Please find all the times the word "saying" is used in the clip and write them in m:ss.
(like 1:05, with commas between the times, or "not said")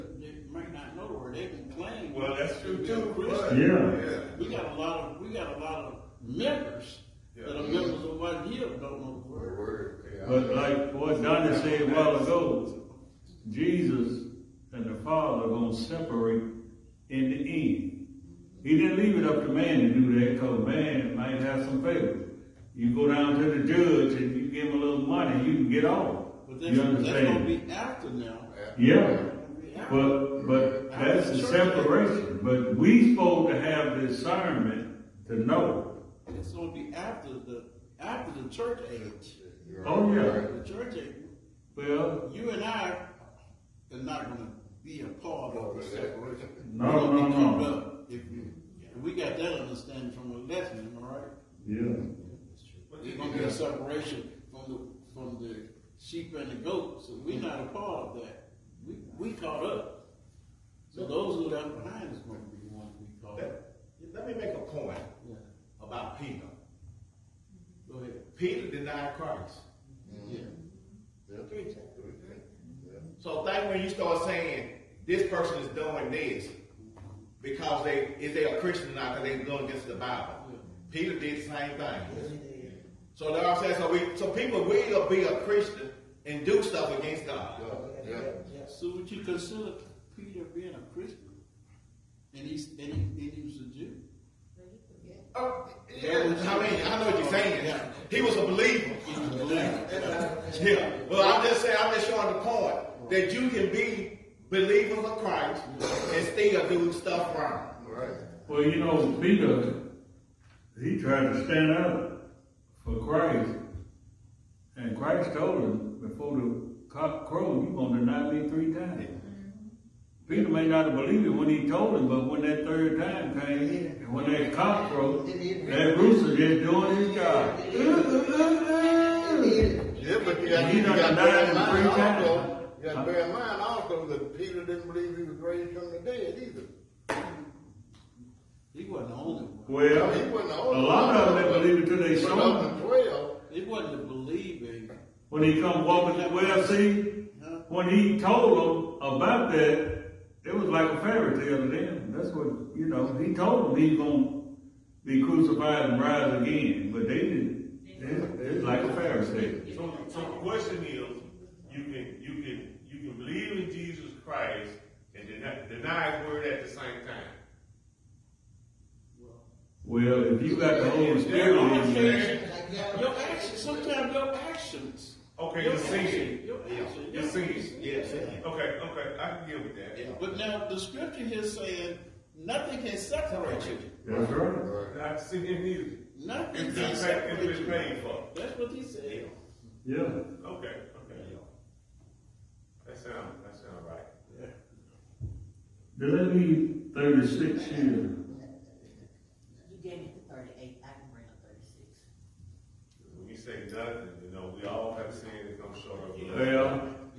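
1:14, 1:23, 1:37, 1:41, 3:01.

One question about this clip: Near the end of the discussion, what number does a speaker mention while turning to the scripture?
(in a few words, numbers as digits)
36.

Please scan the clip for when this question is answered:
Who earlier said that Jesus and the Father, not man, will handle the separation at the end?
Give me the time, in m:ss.
0:11.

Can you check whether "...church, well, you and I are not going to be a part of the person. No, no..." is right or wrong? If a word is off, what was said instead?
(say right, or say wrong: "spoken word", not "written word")
wrong: "separation", not "person".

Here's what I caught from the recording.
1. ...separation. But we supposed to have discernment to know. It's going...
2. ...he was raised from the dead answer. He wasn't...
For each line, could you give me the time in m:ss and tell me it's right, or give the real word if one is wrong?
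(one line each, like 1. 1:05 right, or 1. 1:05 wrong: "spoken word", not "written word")
1. 0:31 right
2. 2:15 wrong: "either", not "answer".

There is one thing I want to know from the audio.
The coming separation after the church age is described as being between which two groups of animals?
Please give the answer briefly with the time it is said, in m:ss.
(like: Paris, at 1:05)
Sheep and the goats, at 0:55.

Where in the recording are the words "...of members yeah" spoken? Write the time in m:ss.
0:05.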